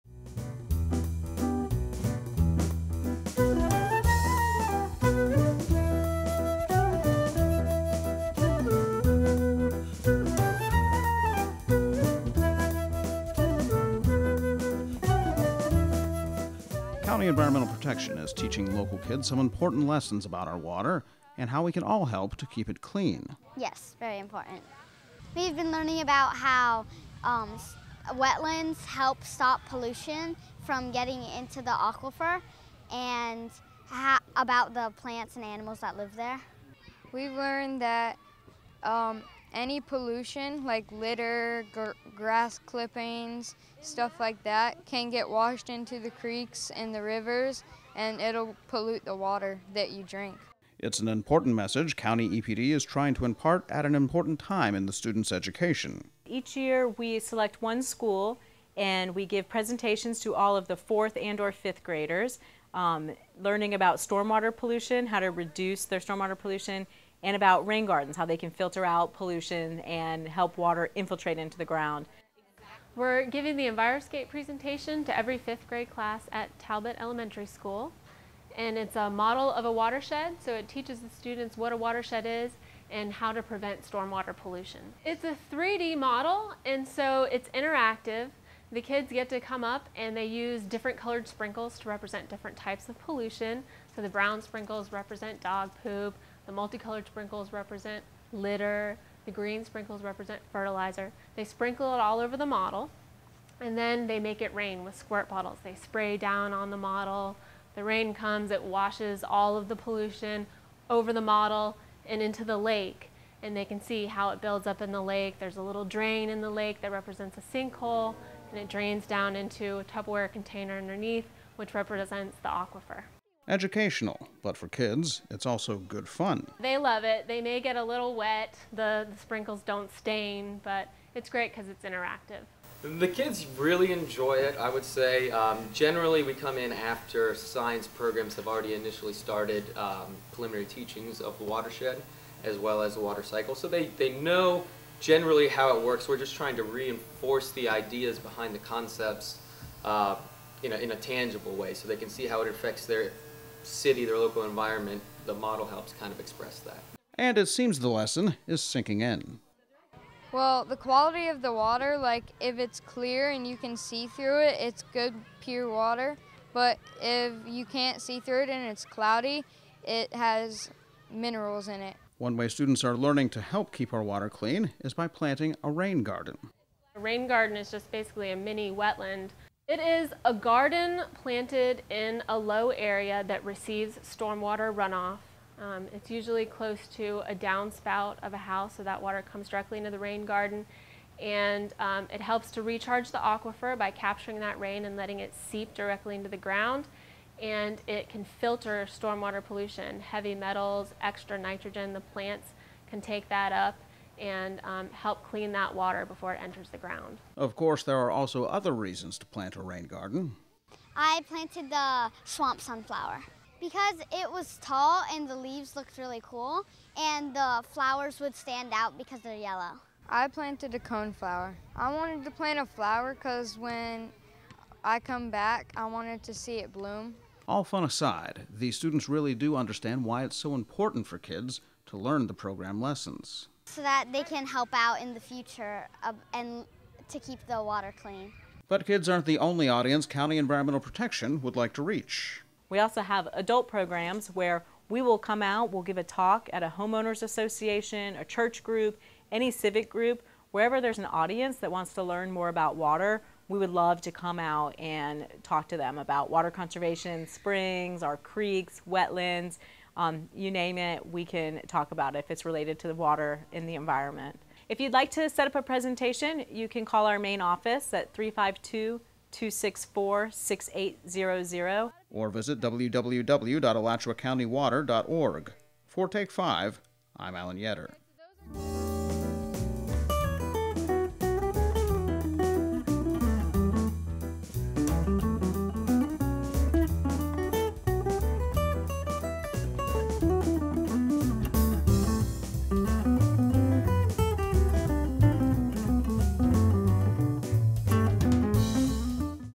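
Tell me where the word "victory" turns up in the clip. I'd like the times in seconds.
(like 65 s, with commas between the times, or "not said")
not said.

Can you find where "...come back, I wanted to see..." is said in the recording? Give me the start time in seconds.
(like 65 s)
224 s.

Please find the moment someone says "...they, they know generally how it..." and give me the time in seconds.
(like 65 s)
143 s.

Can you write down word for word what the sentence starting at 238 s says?
But kids aren't the only audience County Environmental Protection would like to reach.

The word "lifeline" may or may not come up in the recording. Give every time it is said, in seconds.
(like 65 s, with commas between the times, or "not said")
not said.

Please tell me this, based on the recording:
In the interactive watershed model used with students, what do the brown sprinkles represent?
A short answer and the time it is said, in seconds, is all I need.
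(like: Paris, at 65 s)
dog poop, at 95 s.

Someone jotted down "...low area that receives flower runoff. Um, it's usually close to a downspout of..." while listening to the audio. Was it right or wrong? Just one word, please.
wrong.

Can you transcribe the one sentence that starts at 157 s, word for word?
And it seems the lesson is sinking in.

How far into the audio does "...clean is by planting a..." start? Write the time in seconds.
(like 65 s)
174 s.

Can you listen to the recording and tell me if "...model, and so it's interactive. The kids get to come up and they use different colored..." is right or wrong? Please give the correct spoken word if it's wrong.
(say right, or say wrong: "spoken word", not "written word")
right.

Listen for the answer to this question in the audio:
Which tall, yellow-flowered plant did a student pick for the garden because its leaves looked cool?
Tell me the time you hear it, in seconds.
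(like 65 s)
212 s.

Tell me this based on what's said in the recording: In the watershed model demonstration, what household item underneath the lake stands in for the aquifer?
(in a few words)
Tupperware container.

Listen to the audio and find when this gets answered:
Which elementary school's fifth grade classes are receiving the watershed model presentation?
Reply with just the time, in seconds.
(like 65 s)
76 s.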